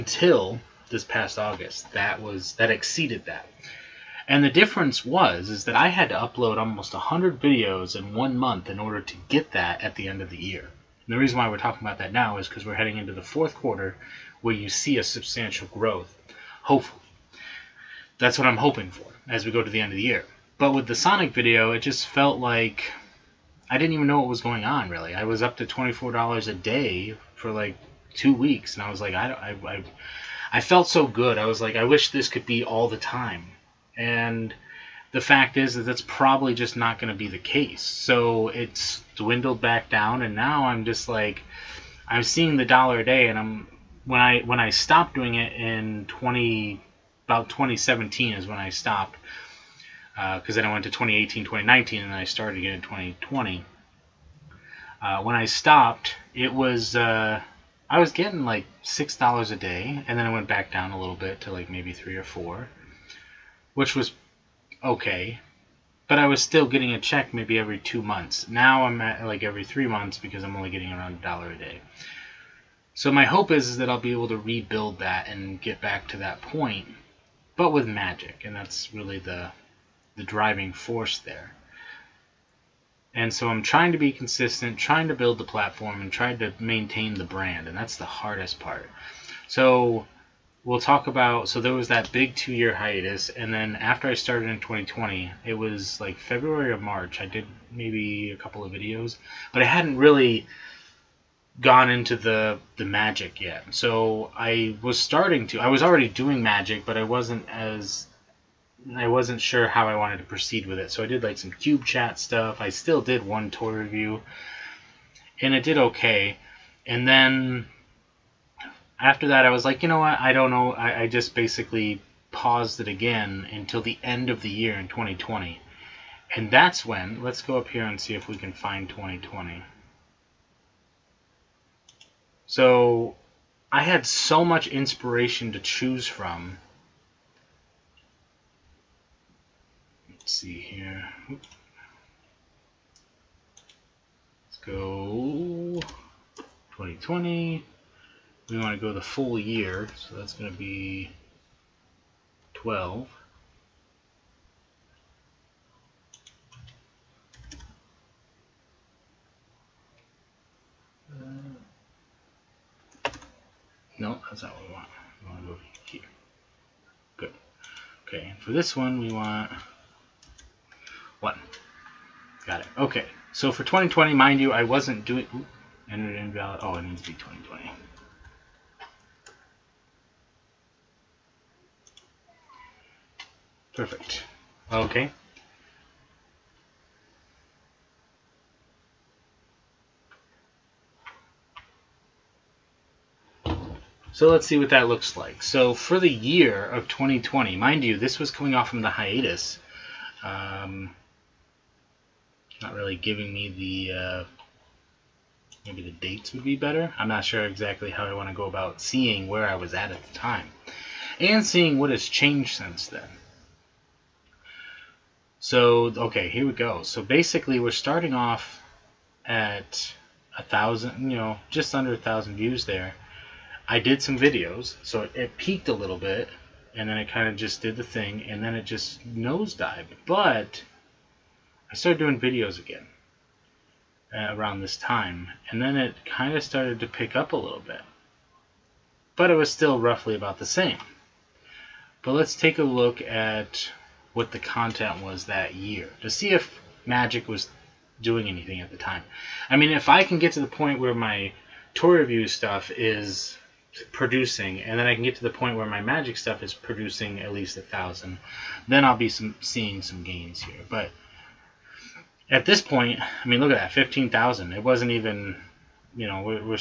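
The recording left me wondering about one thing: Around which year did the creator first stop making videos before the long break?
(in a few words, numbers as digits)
2017.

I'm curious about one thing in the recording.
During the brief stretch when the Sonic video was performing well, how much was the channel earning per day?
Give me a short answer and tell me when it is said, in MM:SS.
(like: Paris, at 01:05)
$24, at 00:25.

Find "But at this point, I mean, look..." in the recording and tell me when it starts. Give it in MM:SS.
04:20.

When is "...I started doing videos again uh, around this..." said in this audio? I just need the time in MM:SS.
03:51.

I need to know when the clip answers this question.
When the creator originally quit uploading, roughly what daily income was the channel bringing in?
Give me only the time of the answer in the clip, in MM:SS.
00:58.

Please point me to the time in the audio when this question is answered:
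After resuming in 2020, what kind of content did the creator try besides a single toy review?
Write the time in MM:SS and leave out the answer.
01:51.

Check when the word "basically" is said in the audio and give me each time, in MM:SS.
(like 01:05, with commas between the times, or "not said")
02:01, 03:37.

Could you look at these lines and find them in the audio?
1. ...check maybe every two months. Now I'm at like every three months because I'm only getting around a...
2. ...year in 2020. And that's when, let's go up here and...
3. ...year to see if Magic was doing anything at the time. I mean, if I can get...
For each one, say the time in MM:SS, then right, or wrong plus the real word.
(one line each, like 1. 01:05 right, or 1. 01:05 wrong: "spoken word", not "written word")
1. 01:06 right
2. 02:04 right
3. 04:05 right.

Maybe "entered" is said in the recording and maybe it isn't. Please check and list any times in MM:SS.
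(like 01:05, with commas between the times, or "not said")
02:55.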